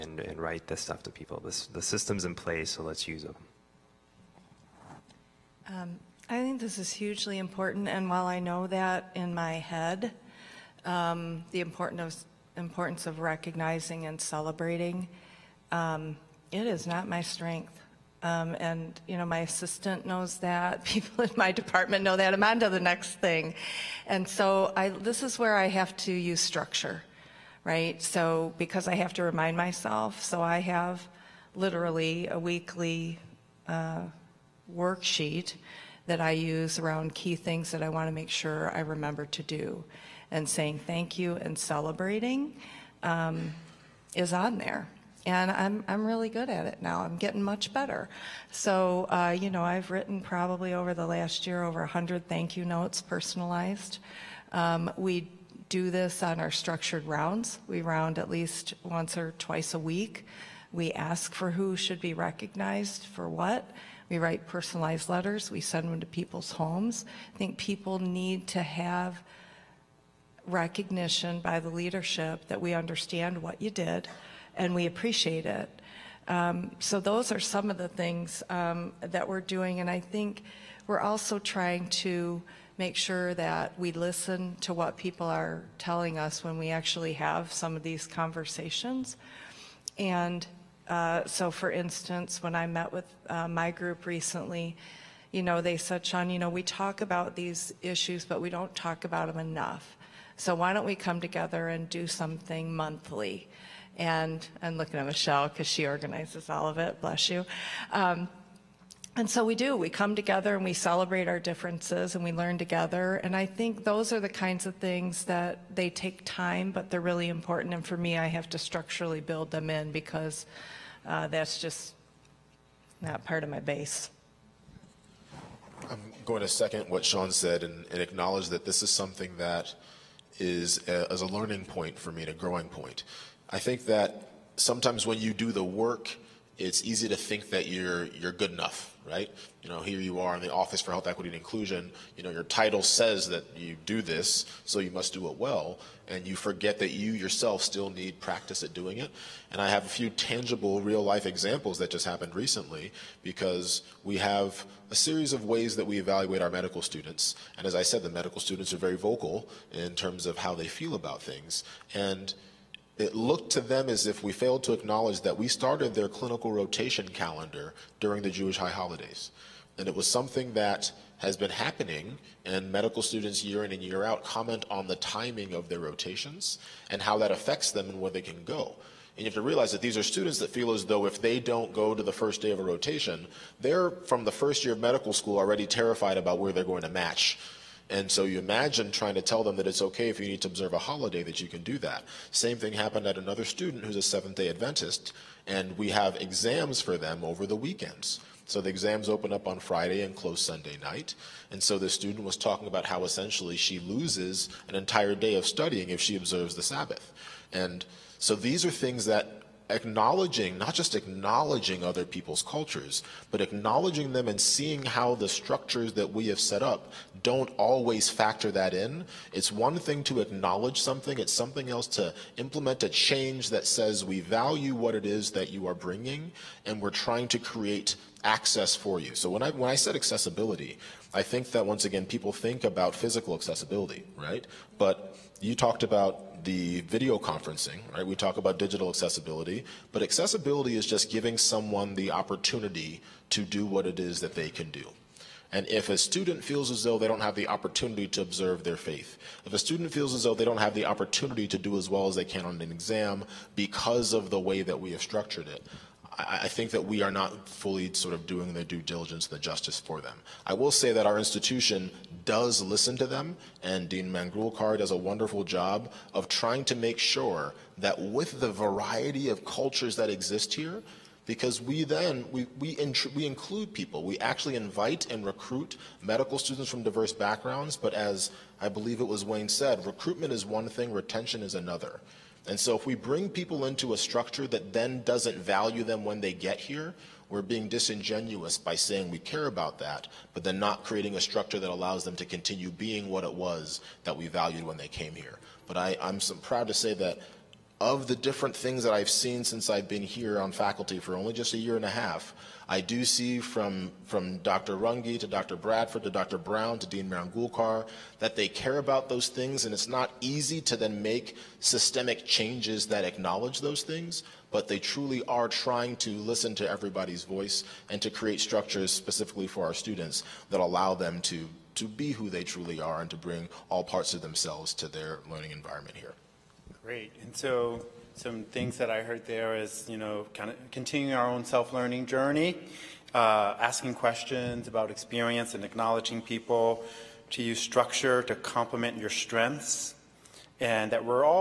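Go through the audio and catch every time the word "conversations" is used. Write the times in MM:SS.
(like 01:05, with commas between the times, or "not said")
01:28.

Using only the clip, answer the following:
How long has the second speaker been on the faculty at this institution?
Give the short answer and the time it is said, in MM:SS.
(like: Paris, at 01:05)
a year and a half, at 05:01.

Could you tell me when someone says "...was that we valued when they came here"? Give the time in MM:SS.
04:53.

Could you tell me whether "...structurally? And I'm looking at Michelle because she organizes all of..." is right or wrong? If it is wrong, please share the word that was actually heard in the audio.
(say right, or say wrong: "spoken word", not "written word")
wrong: "monthly", not "structurally".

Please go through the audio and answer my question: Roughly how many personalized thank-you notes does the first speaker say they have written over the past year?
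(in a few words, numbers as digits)
over 100.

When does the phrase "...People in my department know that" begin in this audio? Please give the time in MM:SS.
00:20.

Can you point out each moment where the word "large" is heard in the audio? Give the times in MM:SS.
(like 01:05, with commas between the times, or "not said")
not said.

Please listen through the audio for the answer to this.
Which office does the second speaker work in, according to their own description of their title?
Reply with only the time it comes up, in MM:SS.
02:20.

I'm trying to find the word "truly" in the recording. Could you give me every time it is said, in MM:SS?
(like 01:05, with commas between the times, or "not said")
05:14, 05:22.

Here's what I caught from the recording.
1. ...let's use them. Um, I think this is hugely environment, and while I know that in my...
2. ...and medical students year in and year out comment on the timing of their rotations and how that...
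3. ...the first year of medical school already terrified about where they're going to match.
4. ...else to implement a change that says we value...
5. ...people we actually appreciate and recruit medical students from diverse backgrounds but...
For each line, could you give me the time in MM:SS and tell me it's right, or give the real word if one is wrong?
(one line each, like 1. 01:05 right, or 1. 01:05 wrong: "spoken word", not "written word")
1. 00:02 wrong: "important", not "environment"
2. 02:52 right
3. 03:04 right
4. 03:41 right
5. 04:33 wrong: "invite", not "appreciate".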